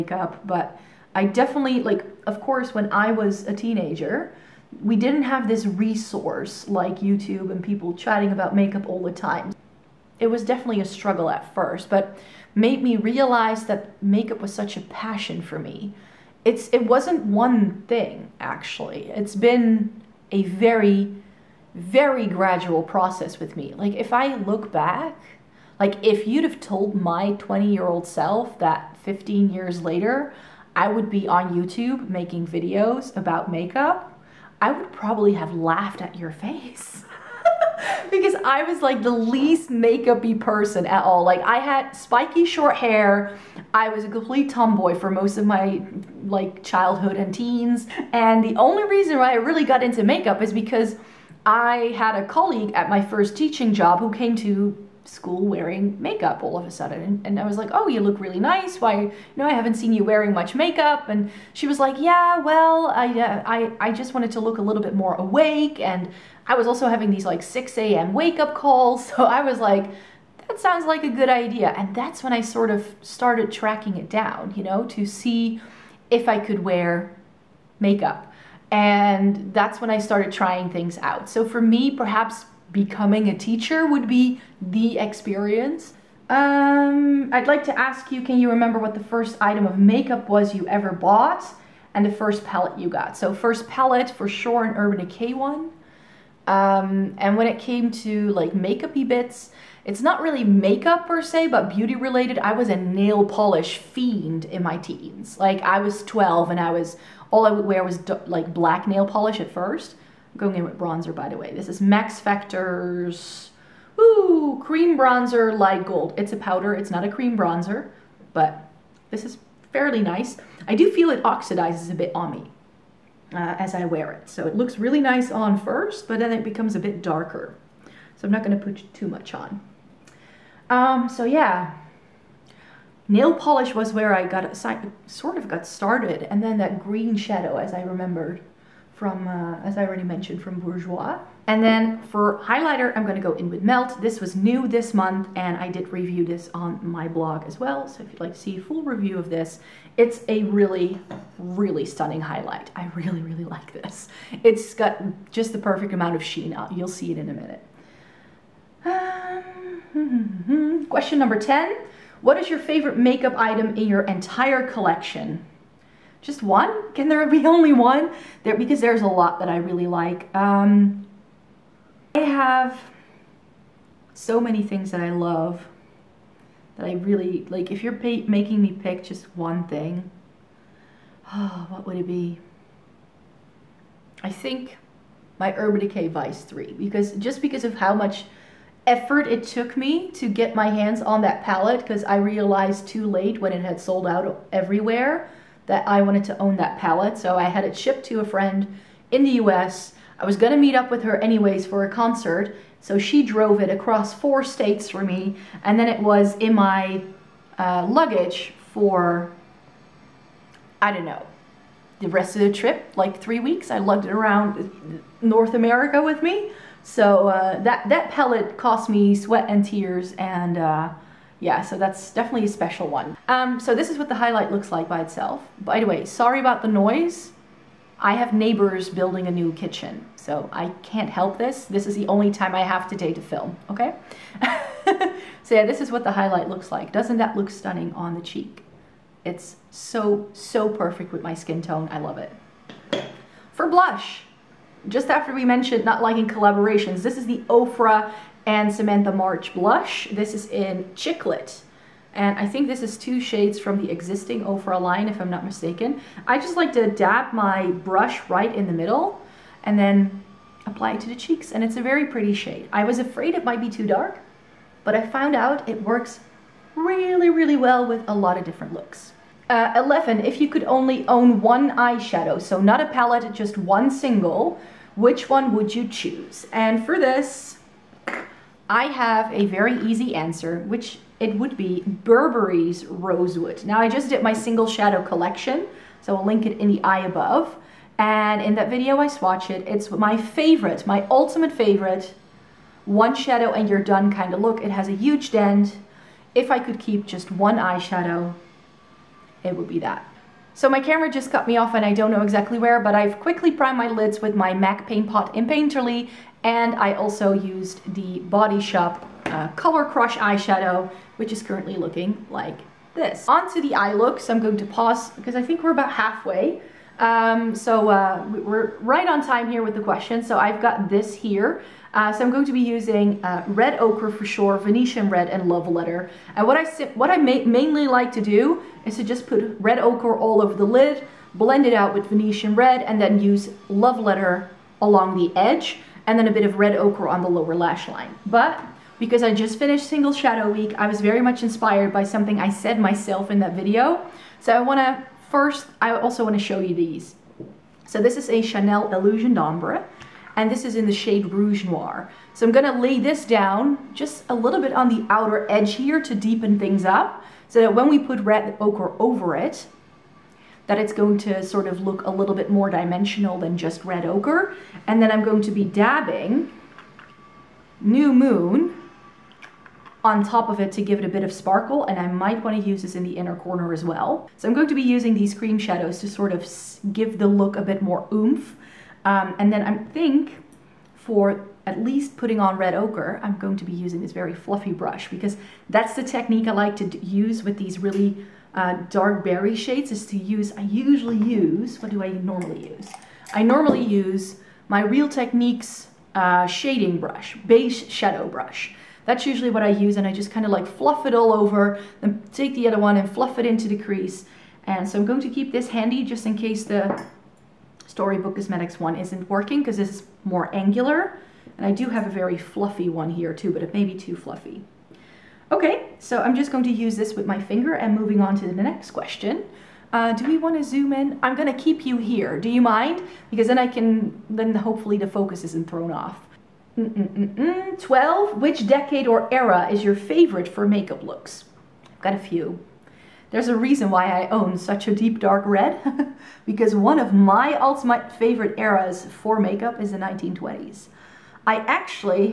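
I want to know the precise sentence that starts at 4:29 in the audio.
Uh, 11, if you could only own one eyeshadow, so not a palette, just one single, which one would you choose?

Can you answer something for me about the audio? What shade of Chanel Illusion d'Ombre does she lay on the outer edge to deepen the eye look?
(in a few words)
Rouge Noir.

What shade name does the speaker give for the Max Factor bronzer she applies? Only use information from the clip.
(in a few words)
Light gold.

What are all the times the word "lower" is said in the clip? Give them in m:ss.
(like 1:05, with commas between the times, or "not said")
5:37.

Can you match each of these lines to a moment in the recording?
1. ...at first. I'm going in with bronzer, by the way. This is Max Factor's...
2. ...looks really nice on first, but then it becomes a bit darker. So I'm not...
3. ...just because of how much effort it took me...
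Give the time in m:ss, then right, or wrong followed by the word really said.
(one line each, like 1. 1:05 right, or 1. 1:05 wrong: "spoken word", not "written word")
1. 1:49 right
2. 2:04 right
3. 3:07 right.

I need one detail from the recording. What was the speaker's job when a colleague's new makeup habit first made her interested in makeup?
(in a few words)
Teaching.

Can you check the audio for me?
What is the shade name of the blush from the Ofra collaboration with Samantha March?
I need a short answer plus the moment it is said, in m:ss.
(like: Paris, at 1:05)
Chicklit, at 4:10.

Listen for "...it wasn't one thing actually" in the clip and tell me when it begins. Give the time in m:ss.
0:16.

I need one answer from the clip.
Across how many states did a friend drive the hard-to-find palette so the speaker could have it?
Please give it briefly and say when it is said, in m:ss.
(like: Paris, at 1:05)
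4, at 3:24.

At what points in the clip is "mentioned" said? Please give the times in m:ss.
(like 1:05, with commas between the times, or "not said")
2:20, 4:05.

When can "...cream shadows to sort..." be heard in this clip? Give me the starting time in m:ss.
6:15.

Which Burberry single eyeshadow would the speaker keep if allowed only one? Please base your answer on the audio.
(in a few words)
Rosewood.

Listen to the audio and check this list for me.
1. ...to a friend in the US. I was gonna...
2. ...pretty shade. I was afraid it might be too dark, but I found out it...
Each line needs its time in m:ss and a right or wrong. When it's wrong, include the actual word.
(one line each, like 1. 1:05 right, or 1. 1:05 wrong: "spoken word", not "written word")
1. 3:18 right
2. 4:22 right.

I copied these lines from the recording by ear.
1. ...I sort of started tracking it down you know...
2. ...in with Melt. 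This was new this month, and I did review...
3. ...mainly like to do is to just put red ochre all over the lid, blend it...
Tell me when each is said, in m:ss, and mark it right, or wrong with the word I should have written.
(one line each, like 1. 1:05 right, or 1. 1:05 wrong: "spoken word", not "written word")
1. 1:12 right
2. 2:23 right
3. 5:27 right.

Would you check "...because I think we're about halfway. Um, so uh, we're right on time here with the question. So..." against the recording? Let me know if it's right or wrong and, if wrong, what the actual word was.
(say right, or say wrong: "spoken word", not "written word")
right.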